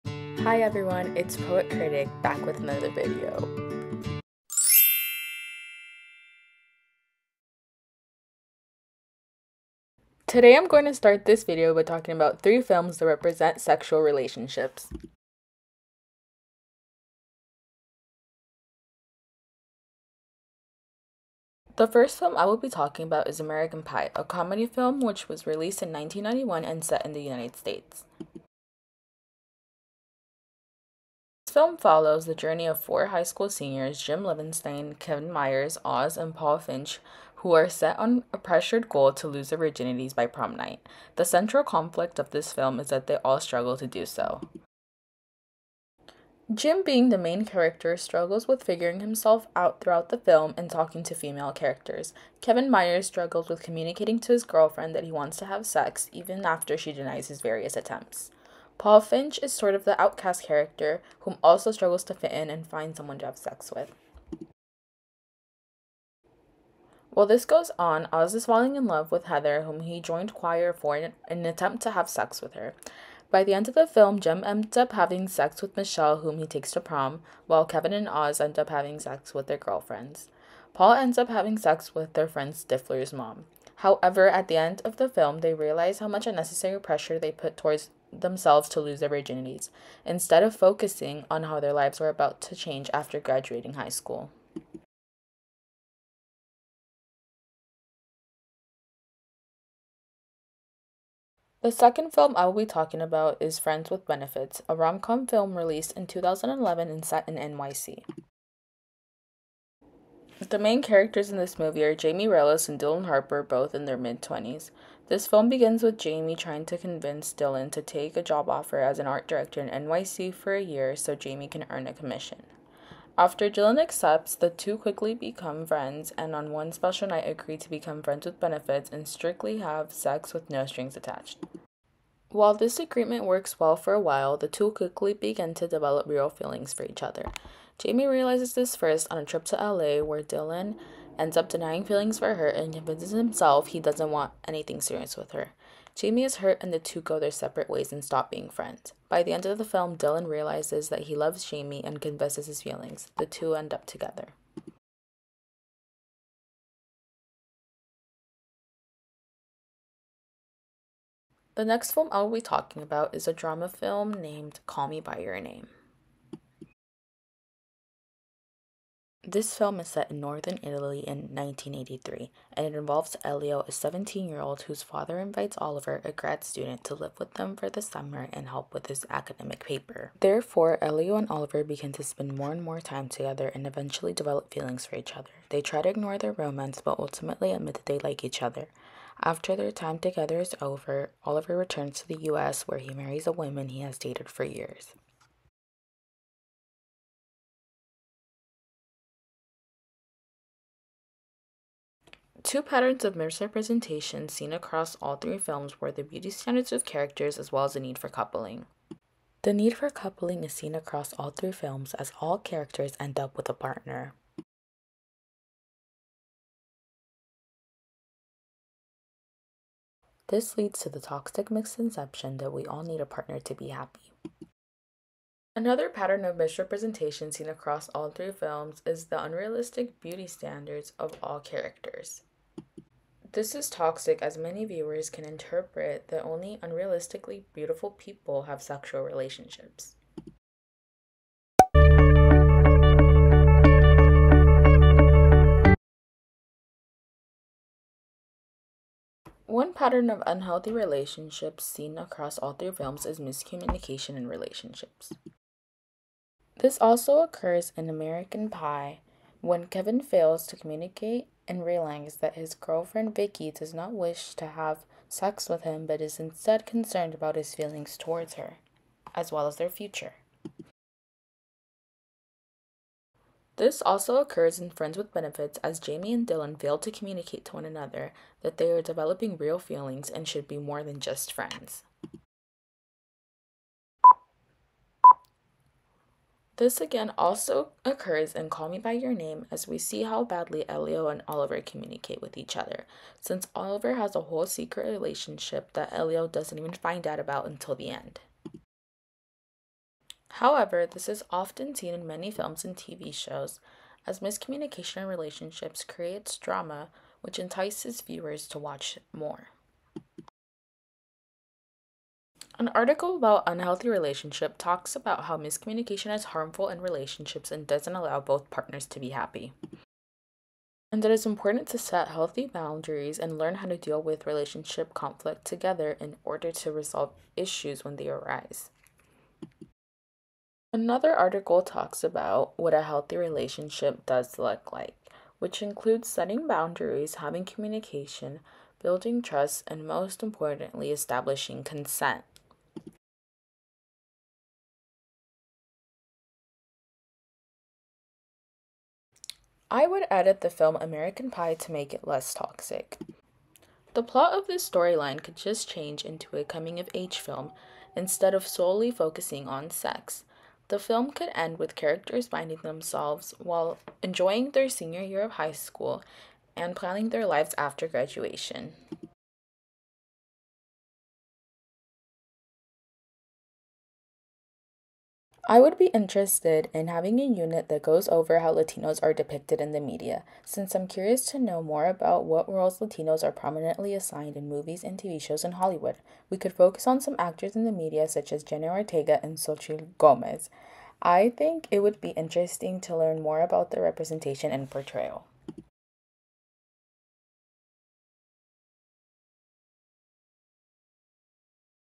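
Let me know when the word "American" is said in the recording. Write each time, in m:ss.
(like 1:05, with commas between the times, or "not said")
0:23, 4:17, 5:50.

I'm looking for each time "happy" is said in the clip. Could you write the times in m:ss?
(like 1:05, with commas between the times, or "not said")
3:43, 5:19.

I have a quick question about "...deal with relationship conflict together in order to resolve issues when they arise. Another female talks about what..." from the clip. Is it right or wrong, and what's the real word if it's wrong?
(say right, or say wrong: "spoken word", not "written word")
wrong: "article", not "female".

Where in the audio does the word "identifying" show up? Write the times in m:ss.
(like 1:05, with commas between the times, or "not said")
not said.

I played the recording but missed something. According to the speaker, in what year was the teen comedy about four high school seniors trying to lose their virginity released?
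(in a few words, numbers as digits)
1991.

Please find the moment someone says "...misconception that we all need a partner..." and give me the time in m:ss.
3:41.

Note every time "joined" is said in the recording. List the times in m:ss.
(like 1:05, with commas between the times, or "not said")
1:10.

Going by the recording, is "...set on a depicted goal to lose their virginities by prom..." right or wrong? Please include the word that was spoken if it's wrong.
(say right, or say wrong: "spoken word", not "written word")
wrong: "pressured", not "depicted".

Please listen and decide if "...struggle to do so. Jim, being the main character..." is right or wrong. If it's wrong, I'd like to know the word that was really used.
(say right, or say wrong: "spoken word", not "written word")
right.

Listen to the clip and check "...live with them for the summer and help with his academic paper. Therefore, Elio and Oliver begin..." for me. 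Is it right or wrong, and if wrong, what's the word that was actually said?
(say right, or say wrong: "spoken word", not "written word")
right.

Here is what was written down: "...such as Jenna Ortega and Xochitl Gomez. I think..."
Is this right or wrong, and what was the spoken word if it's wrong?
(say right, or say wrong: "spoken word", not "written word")
right.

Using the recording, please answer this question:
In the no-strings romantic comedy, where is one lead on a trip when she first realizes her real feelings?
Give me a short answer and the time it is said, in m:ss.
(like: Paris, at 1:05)
LA, at 2:19.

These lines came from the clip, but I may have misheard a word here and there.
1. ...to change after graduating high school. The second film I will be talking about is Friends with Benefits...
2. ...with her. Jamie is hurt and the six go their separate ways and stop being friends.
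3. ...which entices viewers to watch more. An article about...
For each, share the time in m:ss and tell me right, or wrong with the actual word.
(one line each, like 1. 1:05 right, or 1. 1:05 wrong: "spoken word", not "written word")
1. 1:32 right
2. 2:25 wrong: "two", not "six"
3. 5:07 right.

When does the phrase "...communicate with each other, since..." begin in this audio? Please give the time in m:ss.
4:51.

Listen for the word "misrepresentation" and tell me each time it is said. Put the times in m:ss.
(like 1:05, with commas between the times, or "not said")
3:23, 3:46.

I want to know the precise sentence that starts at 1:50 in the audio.
The main characters in this movie are Jamie Rellis and Dylan Harper, both in their mid 20s.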